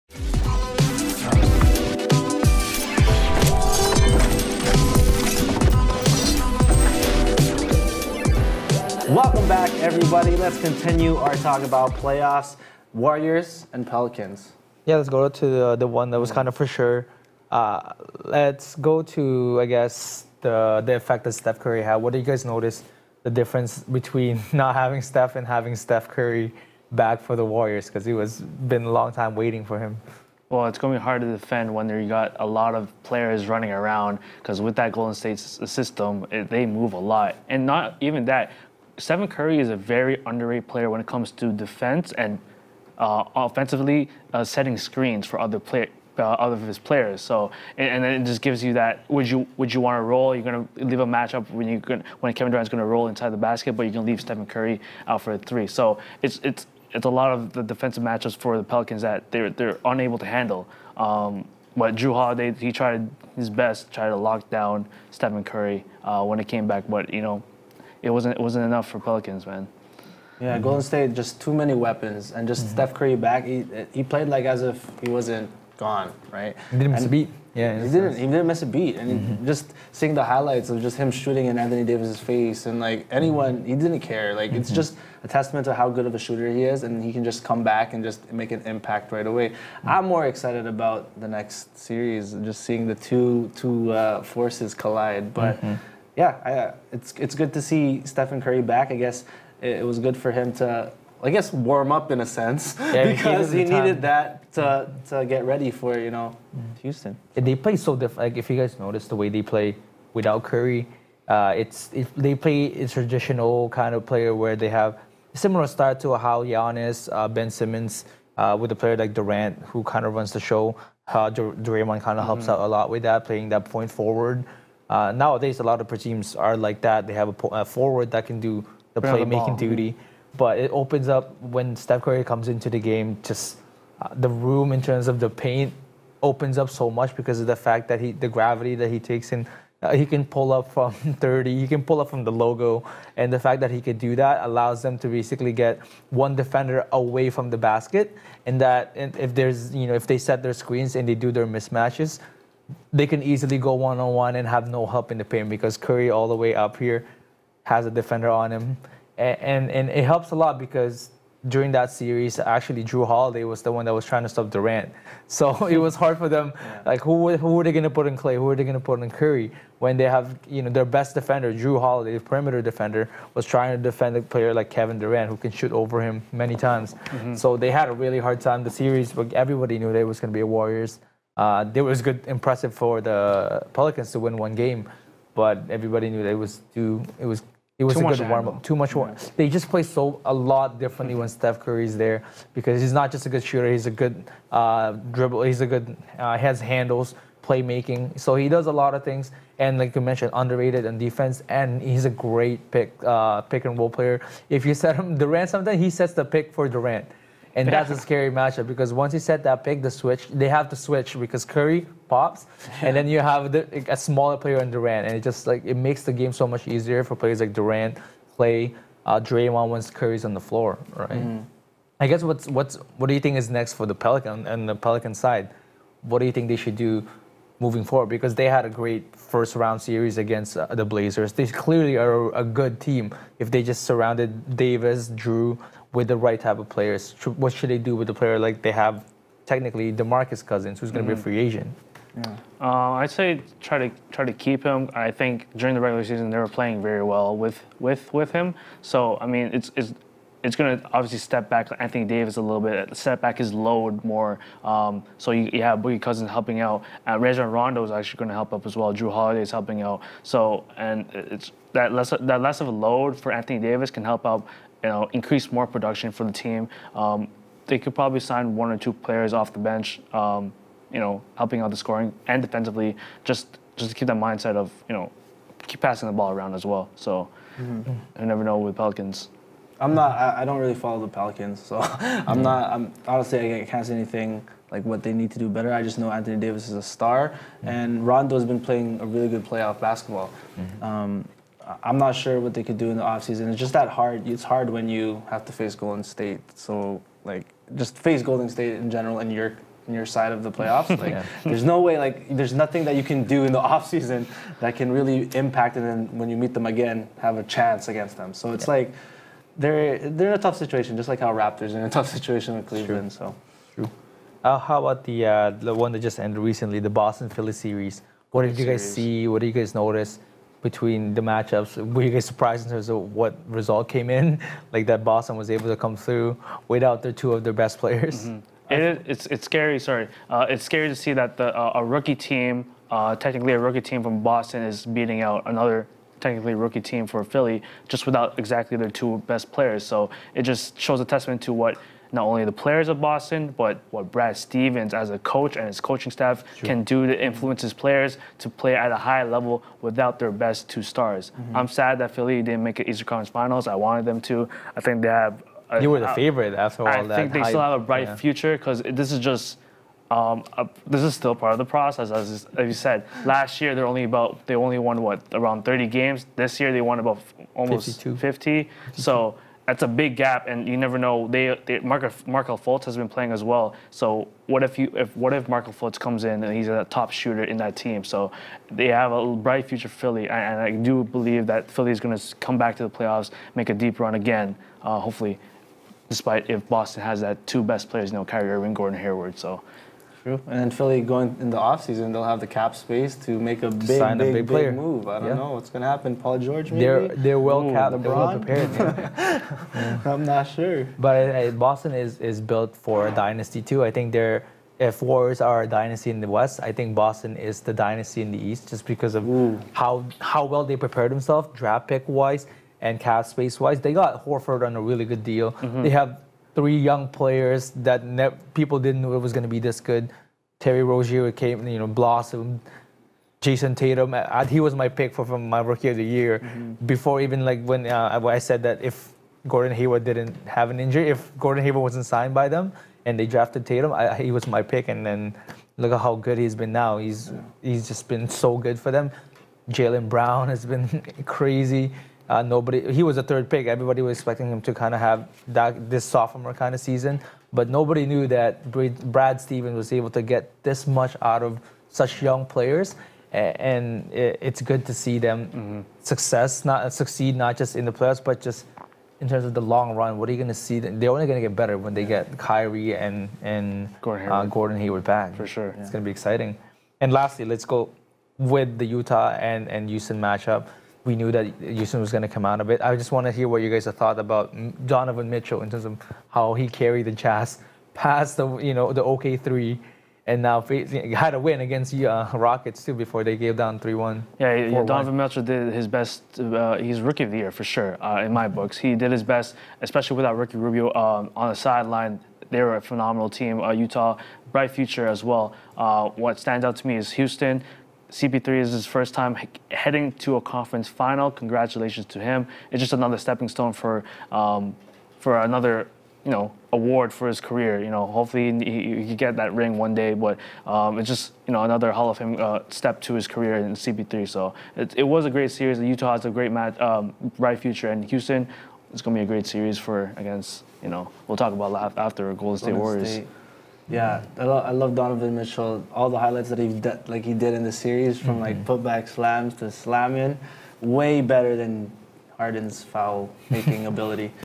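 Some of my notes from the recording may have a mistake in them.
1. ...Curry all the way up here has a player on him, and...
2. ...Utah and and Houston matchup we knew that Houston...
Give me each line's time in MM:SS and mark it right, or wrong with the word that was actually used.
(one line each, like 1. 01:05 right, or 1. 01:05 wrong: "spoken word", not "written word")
1. 02:35 wrong: "defender", not "player"
2. 07:48 right.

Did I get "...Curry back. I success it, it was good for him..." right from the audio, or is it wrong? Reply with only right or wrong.
wrong.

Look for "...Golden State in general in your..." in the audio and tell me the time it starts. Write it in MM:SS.
04:58.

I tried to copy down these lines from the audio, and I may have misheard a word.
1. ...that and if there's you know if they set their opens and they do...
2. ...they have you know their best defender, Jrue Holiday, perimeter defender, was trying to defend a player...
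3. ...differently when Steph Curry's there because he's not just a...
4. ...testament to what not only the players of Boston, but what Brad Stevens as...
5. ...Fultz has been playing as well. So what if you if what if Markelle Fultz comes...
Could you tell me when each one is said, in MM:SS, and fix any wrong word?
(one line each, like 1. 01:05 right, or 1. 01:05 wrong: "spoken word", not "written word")
1. 02:28 wrong: "screens", not "opens"
2. 02:49 right
3. 03:10 right
4. 05:41 right
5. 06:12 right.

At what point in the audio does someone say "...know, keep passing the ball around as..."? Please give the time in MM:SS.
04:34.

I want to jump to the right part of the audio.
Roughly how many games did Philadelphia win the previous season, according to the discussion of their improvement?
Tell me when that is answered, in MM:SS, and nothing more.
06:05.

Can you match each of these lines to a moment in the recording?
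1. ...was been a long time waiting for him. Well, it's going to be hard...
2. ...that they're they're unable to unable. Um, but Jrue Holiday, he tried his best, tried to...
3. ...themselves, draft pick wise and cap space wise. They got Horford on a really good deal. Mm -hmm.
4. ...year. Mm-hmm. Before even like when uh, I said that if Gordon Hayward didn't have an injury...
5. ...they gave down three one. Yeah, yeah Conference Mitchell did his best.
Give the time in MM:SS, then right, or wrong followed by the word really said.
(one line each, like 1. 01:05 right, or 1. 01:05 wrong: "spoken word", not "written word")
1. 00:28 right
2. 00:59 wrong: "handle", not "unable"
3. 06:51 right
4. 07:06 right
5. 08:03 wrong: "Donovan", not "Conference".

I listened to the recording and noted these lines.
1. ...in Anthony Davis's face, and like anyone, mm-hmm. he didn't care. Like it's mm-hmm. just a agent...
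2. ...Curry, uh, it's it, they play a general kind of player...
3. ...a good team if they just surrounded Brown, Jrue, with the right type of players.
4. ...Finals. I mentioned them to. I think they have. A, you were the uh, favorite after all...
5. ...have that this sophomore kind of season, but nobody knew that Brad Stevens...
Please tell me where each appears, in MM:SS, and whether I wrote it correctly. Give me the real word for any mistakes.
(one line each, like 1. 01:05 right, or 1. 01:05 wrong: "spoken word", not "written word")
1. 01:21 wrong: "testament", not "agent"
2. 01:50 wrong: "traditional", not "general"
3. 03:52 wrong: "Davis", not "Brown"
4. 05:53 wrong: "wanted", not "mentioned"
5. 07:25 right.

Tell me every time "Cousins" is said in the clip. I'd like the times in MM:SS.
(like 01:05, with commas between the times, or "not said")
04:00, 04:16.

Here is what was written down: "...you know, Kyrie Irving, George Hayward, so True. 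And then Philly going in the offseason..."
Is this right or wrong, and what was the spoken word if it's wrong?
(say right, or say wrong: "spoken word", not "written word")
wrong: "Gordon", not "George".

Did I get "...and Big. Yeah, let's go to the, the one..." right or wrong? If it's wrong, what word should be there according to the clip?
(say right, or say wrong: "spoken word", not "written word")
wrong: "Pelicans", not "Big".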